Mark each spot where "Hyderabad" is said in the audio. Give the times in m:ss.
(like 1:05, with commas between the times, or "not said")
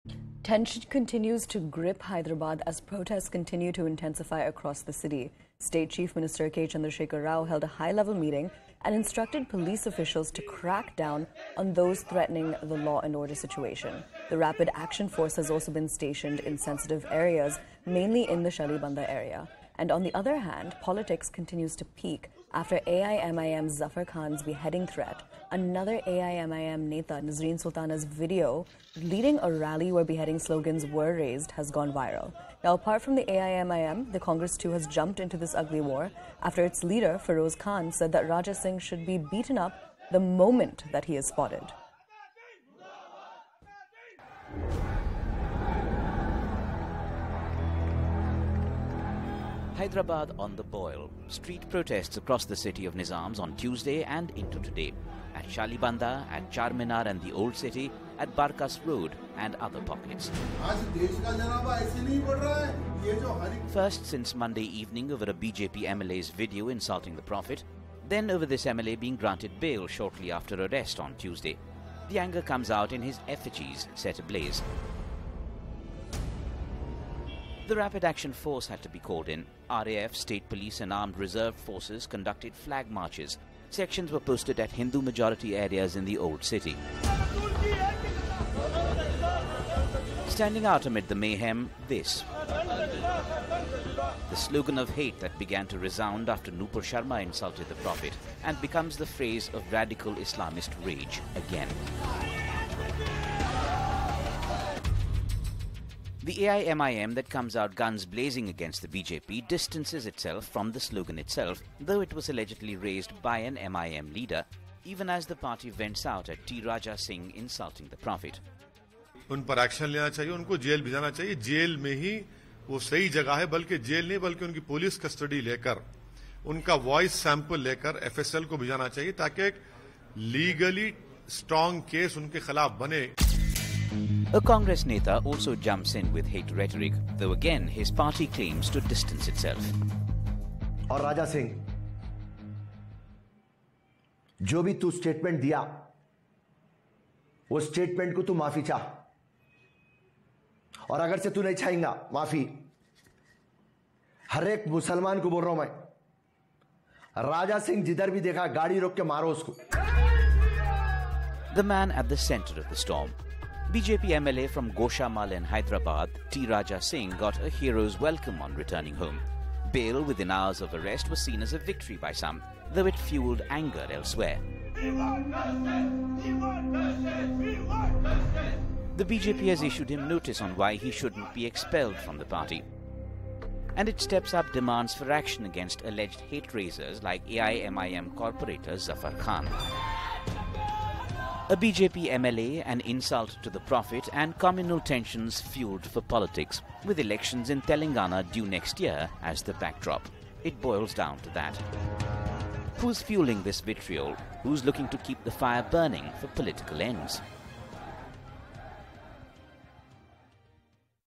0:02, 0:49, 2:45.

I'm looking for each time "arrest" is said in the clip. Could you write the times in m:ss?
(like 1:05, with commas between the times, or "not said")
1:10, 2:50.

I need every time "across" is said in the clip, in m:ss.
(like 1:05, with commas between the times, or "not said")
0:04, 0:52.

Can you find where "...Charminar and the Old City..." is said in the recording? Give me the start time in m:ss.
0:56.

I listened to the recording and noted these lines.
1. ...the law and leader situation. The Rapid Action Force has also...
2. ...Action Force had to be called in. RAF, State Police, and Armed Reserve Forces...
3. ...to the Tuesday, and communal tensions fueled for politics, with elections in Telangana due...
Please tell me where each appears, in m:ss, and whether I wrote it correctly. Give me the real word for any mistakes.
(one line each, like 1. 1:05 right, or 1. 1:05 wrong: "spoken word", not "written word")
1. 0:12 wrong: "order", not "leader"
2. 1:18 right
3. 3:13 wrong: "Prophet", not "Tuesday".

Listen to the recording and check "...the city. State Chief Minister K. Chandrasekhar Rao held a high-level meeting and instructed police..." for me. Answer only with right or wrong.
right.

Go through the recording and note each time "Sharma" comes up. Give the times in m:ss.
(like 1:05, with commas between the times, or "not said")
1:36.